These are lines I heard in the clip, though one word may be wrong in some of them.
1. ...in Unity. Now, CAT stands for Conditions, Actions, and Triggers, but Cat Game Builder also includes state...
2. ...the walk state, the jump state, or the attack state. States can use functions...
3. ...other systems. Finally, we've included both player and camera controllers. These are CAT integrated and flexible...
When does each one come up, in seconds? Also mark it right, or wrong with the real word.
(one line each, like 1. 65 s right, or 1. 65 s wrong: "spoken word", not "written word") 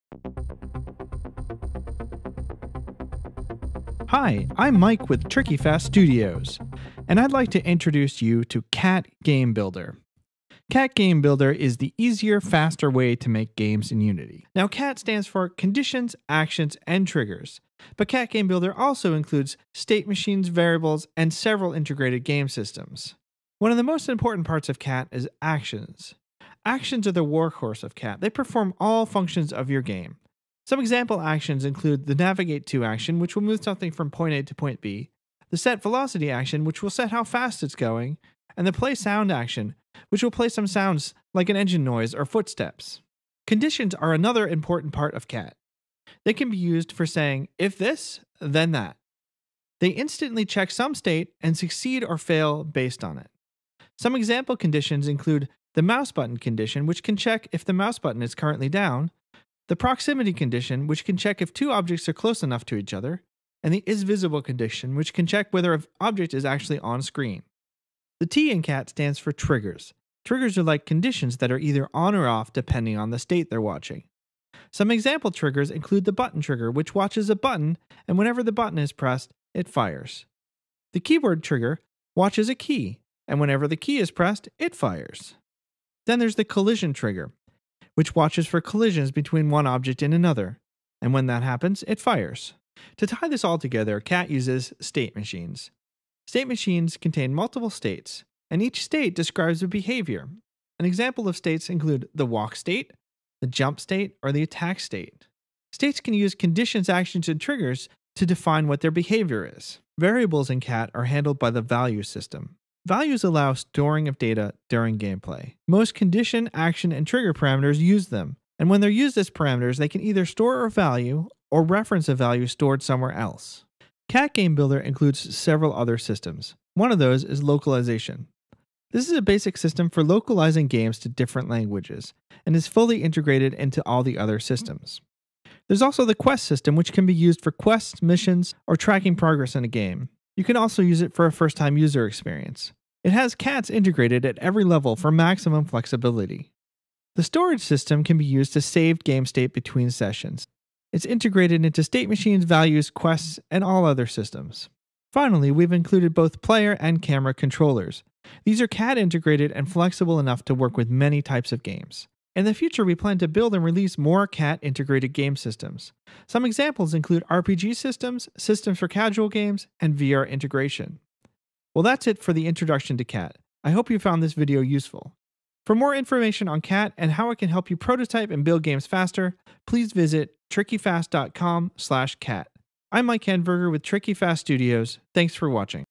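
1. 13 s right
2. 102 s wrong: "conditions", not "functions"
3. 153 s right.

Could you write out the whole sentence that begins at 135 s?
There's also the quest system, which can be used for quests, missions, or tracking progress in a game.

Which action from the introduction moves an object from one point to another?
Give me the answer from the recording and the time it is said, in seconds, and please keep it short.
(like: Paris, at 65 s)
Navigate To, at 32 s.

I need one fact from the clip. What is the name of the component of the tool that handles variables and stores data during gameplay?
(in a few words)
value system.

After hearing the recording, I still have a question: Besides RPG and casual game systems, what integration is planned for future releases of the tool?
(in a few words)
VR integration.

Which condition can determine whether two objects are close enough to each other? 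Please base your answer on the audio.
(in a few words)
proximity condition.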